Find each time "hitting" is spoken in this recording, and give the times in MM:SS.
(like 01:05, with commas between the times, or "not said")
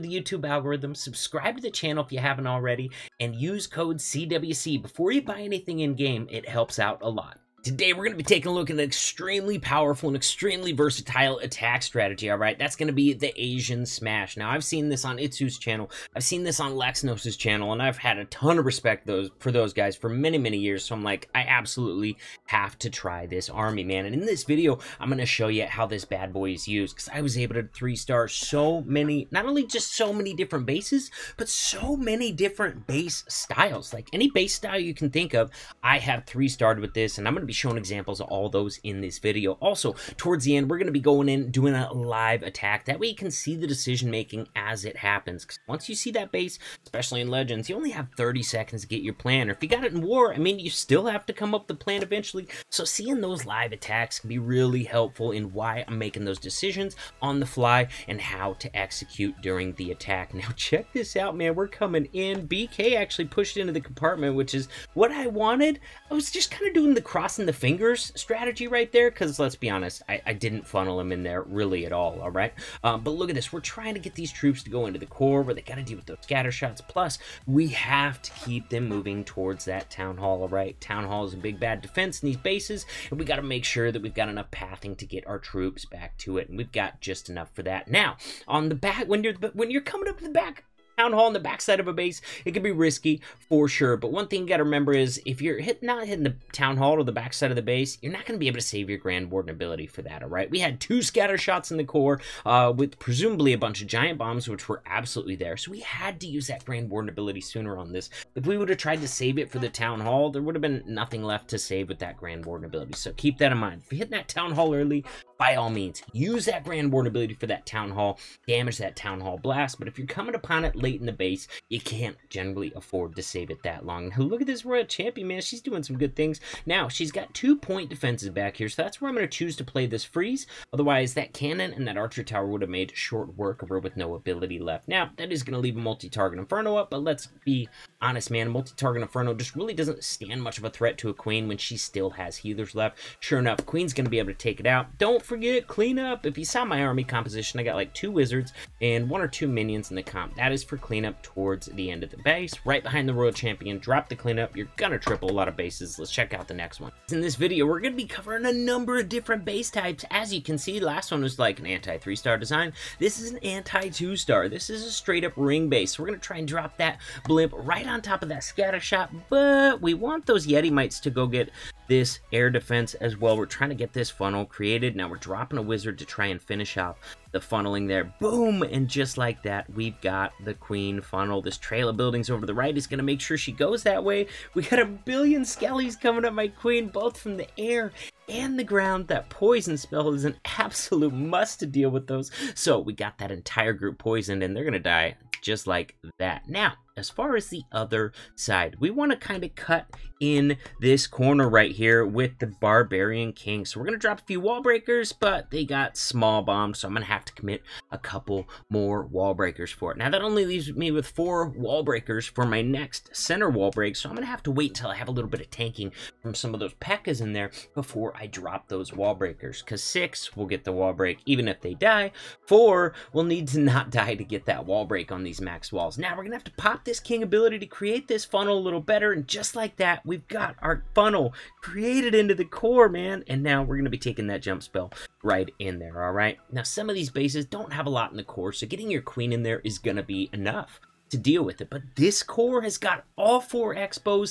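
01:36, 01:53.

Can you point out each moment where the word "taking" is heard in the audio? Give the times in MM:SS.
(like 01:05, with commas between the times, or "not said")
00:08, 03:53.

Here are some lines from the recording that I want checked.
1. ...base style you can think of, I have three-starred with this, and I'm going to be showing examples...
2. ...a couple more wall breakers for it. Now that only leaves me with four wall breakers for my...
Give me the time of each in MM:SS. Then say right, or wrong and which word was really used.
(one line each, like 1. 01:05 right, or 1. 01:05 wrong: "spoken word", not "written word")
1. 00:34 right
2. 03:27 right.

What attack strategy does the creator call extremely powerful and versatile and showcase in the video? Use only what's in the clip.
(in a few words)
Asian Smash.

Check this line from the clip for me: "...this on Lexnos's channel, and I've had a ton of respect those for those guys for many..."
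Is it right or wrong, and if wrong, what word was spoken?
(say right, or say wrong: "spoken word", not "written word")
right.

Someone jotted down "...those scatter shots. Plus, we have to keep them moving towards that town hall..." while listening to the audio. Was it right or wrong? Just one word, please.
right.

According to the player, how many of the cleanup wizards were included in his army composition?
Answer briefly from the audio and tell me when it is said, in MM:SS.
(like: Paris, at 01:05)
2, at 02:27.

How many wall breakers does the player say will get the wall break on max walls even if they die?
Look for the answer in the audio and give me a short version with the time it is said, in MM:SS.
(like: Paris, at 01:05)
6, at 03:39.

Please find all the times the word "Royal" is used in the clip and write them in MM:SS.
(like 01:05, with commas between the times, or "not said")
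02:04, 02:33.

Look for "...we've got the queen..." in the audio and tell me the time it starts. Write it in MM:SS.
02:59.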